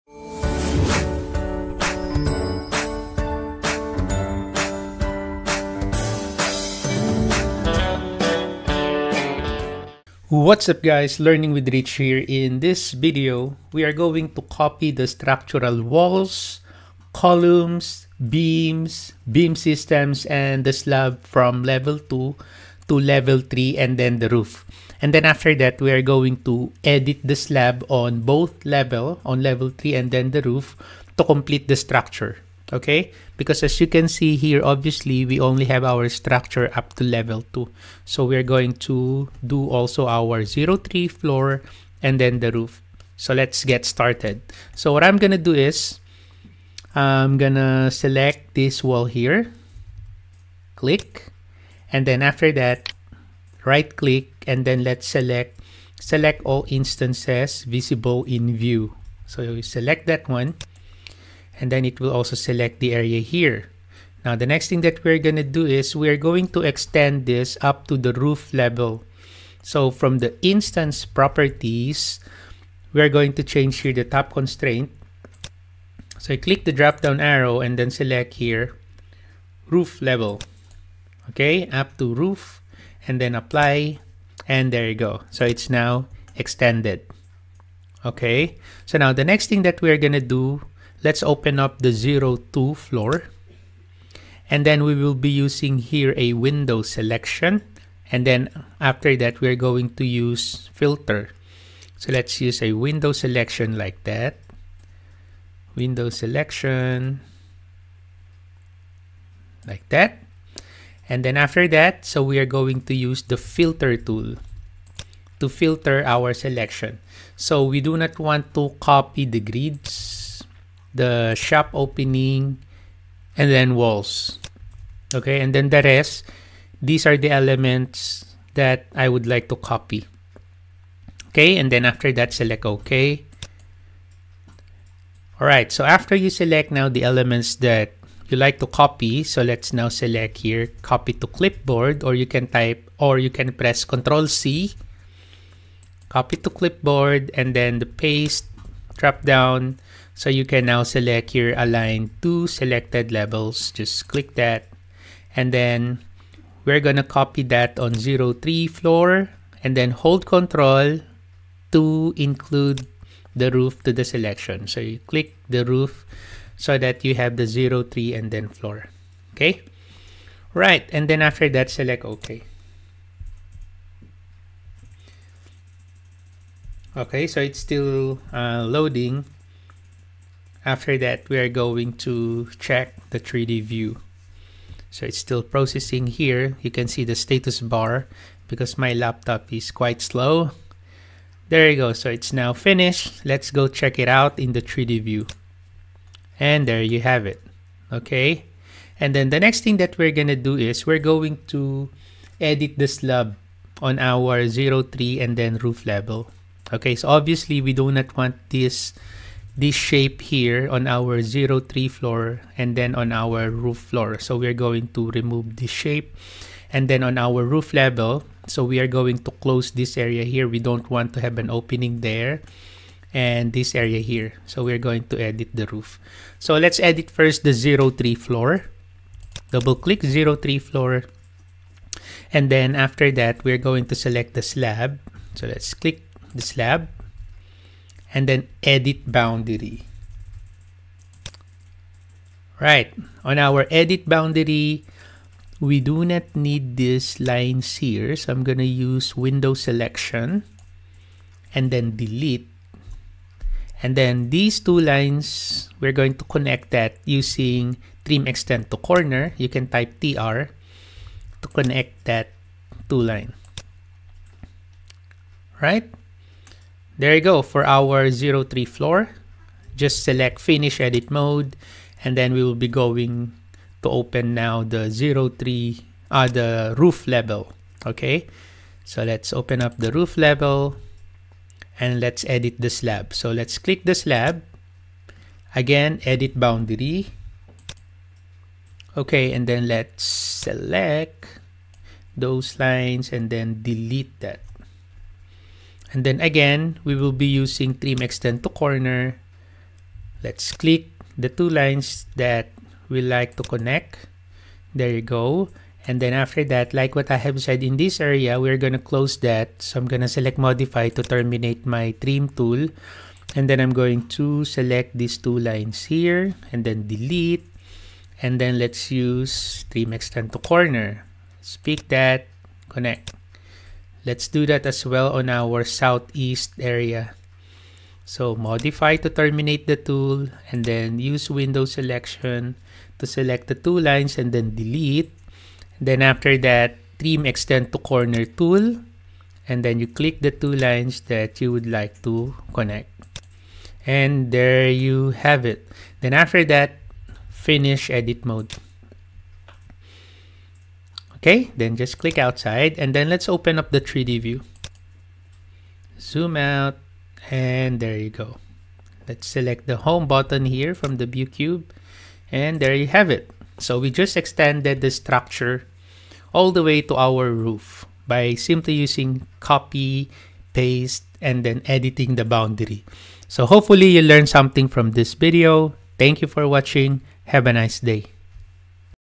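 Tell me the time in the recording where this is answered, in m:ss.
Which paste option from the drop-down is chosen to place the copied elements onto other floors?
2:31.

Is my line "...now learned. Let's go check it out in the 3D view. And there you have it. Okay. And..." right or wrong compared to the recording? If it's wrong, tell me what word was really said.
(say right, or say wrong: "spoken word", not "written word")
wrong: "finished", not "learned".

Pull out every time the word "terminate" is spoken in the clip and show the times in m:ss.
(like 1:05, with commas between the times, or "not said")
5:11, 5:29.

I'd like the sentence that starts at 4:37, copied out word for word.
Okay, so let's open up the roof level and let's edit the slab.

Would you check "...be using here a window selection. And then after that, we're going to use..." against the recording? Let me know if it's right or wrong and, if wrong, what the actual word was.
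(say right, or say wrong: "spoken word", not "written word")
right.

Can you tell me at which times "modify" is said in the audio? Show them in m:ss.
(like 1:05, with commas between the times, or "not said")
5:10, 5:28.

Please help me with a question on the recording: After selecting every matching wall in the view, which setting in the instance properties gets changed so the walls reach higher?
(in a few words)
Top constraint.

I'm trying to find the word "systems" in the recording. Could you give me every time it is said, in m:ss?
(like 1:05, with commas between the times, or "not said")
0:19.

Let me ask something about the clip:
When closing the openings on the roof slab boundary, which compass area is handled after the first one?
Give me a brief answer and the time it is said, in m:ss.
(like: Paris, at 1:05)
Southeast, at 5:25.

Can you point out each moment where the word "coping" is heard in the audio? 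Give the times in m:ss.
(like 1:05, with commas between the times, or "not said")
not said.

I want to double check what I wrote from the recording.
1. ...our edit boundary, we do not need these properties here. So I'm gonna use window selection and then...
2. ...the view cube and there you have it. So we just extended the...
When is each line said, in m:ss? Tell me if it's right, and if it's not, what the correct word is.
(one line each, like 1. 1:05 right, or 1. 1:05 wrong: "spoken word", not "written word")
1. 4:03 wrong: "lines", not "properties"
2. 6:00 right.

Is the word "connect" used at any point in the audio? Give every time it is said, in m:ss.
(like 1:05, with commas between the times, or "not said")
4:16, 4:21, 5:03, 5:22, 5:42.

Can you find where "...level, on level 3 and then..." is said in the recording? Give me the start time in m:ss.
0:28.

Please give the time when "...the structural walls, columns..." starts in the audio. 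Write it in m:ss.
0:14.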